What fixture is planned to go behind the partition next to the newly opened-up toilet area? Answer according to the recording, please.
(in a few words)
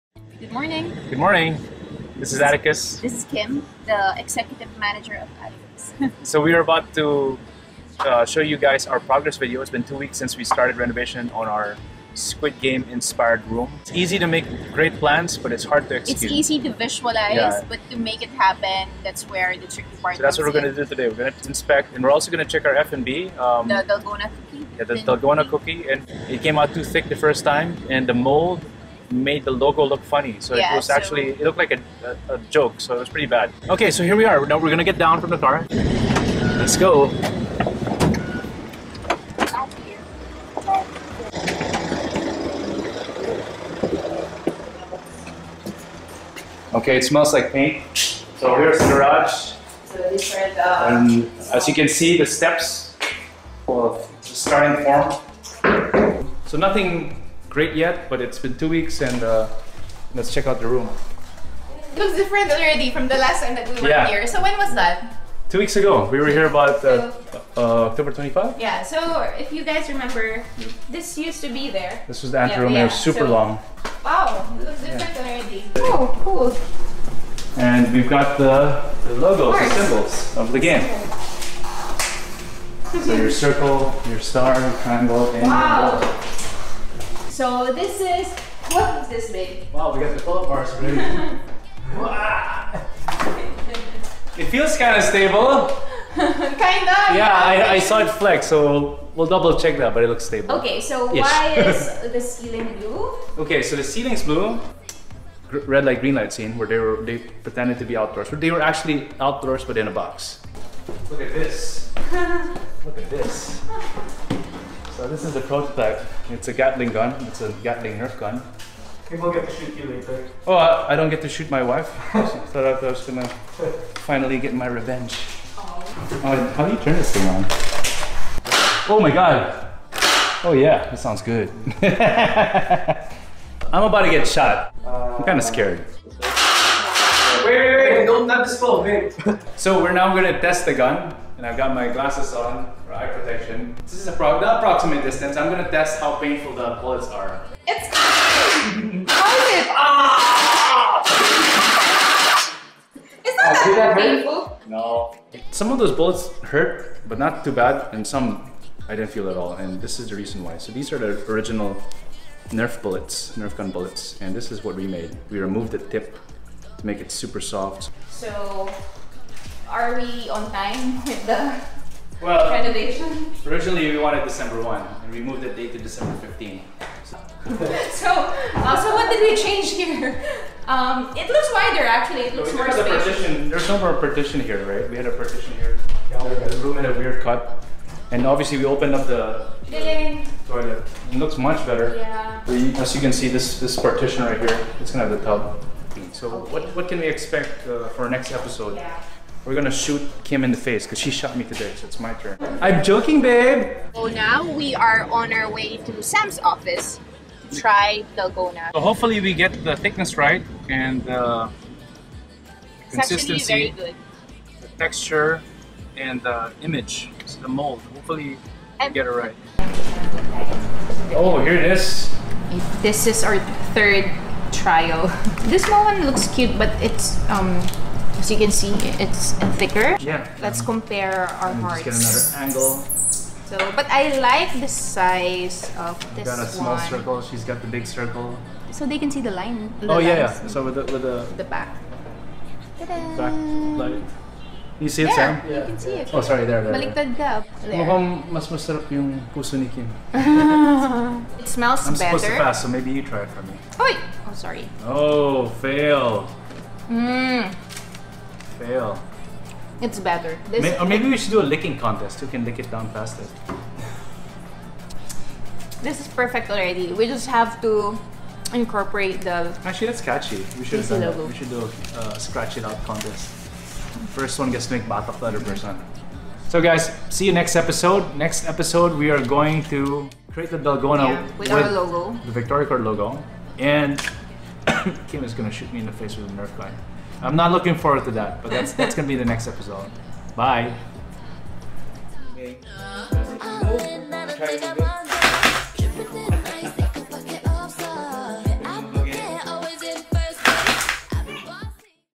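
The tub.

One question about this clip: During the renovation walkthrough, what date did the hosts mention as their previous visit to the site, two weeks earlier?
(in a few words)
October 25.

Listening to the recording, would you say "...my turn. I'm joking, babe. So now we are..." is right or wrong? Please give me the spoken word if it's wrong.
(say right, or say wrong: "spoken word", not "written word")
right.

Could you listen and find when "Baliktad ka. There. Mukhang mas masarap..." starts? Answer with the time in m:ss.
4:06.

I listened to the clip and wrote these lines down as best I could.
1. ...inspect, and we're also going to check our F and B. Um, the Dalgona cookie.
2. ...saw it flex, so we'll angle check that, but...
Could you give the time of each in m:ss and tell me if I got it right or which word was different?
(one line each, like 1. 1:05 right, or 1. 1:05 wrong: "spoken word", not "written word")
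1. 0:21 right
2. 1:37 wrong: "double", not "angle".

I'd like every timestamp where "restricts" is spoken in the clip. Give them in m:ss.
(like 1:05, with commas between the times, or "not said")
not said.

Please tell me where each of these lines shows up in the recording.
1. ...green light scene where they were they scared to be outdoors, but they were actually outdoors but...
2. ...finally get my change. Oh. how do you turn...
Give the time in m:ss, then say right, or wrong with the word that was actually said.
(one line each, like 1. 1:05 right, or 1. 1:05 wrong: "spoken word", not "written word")
1. 1:46 wrong: "pretended", not "scared"
2. 2:04 wrong: "revenge", not "change".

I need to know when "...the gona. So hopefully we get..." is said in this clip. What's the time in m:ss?
3:28.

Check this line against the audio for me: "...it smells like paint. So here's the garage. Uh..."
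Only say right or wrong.
right.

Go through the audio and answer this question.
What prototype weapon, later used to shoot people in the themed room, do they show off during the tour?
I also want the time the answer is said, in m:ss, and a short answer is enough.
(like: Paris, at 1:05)
Gatling Nerf gun, at 1:57.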